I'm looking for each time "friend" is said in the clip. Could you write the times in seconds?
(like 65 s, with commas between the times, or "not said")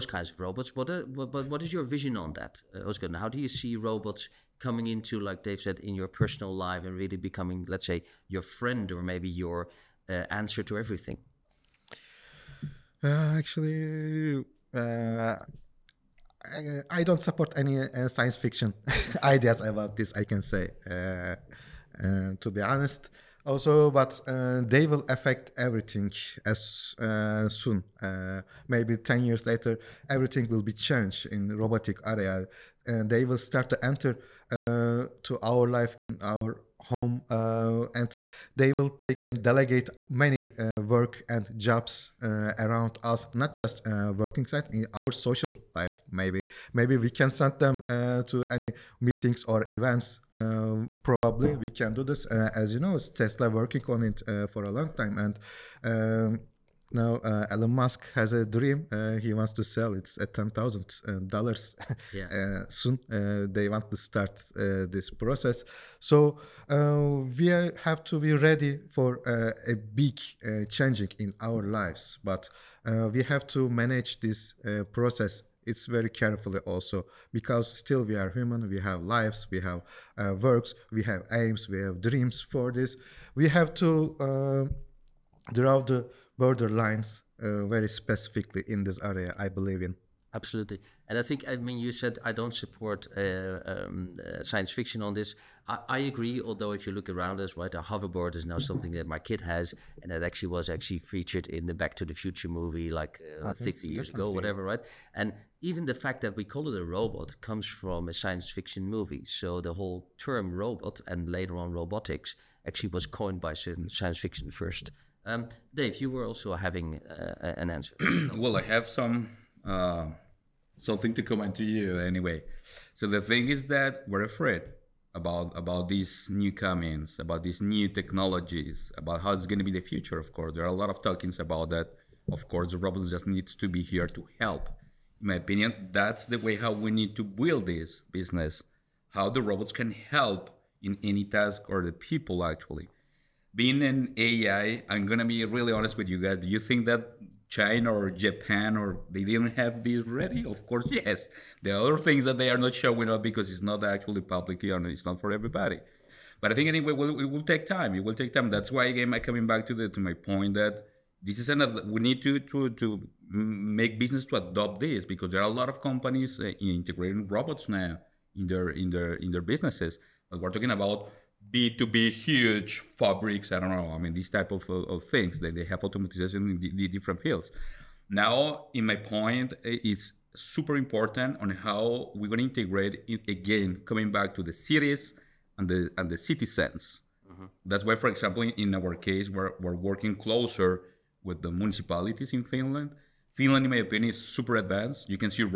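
8 s.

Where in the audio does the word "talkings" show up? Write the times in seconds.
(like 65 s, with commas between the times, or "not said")
131 s, 170 s.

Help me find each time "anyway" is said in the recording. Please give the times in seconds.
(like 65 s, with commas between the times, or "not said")
121 s, 156 s.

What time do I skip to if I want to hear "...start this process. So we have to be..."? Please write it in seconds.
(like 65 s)
63 s.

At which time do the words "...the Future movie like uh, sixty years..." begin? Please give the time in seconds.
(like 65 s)
102 s.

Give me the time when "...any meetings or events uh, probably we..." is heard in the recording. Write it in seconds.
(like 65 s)
48 s.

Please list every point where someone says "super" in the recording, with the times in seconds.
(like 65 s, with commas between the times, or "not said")
180 s, 194 s.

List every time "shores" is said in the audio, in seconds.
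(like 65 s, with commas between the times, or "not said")
not said.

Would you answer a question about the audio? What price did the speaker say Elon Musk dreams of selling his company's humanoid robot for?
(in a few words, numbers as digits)
$10,000.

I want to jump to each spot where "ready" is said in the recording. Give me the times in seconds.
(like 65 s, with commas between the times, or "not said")
68 s, 150 s.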